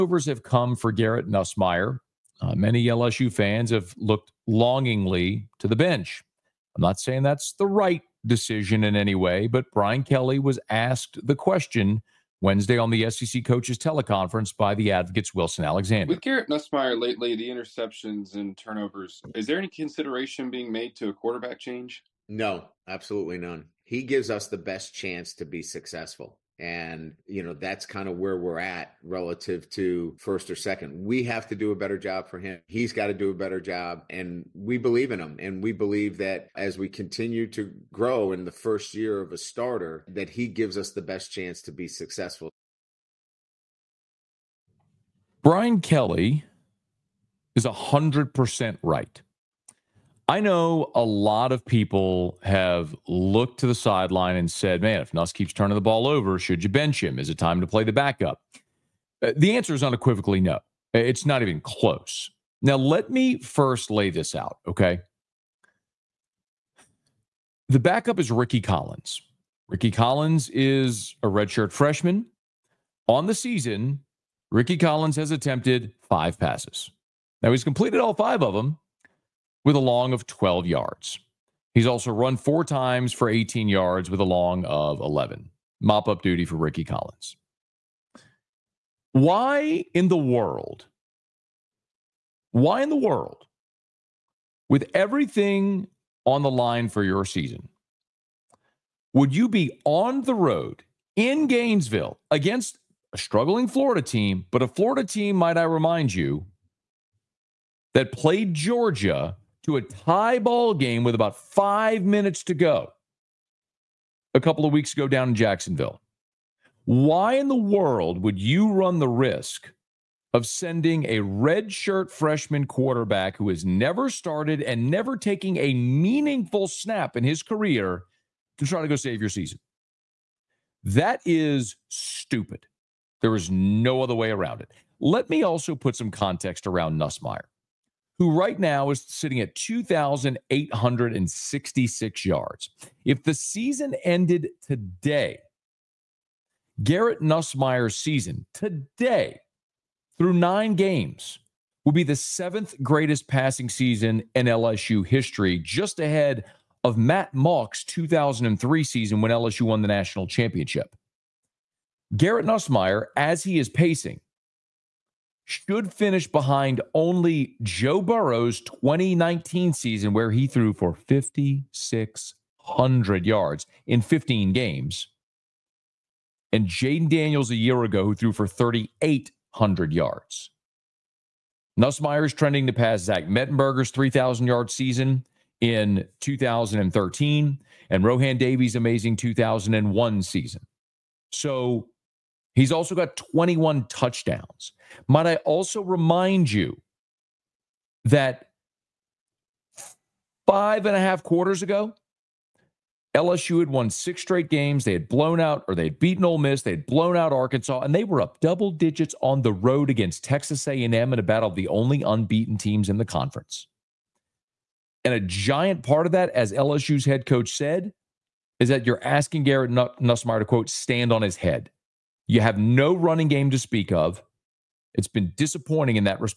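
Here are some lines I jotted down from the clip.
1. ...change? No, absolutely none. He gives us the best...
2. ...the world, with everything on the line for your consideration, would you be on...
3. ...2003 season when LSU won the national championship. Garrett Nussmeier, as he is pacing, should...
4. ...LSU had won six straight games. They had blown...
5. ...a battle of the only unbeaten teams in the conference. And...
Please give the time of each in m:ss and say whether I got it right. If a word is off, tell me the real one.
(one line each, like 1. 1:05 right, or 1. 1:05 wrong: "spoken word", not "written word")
1. 0:21 right
2. 1:32 wrong: "season", not "consideration"
3. 2:37 right
4. 3:23 right
5. 3:31 right.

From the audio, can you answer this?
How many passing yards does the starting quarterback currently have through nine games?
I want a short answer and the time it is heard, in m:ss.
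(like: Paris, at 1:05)
2,866, at 2:19.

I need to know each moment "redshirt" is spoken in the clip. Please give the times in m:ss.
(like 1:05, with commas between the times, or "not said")
1:11, 2:01.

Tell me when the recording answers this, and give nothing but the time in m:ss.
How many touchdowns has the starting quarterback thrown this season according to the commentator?
3:13.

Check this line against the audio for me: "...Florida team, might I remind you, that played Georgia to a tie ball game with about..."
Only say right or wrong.
right.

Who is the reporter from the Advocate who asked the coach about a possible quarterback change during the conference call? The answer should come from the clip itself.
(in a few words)
Wilson Alexander.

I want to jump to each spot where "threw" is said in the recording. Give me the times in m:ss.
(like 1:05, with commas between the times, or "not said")
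2:50, 2:58.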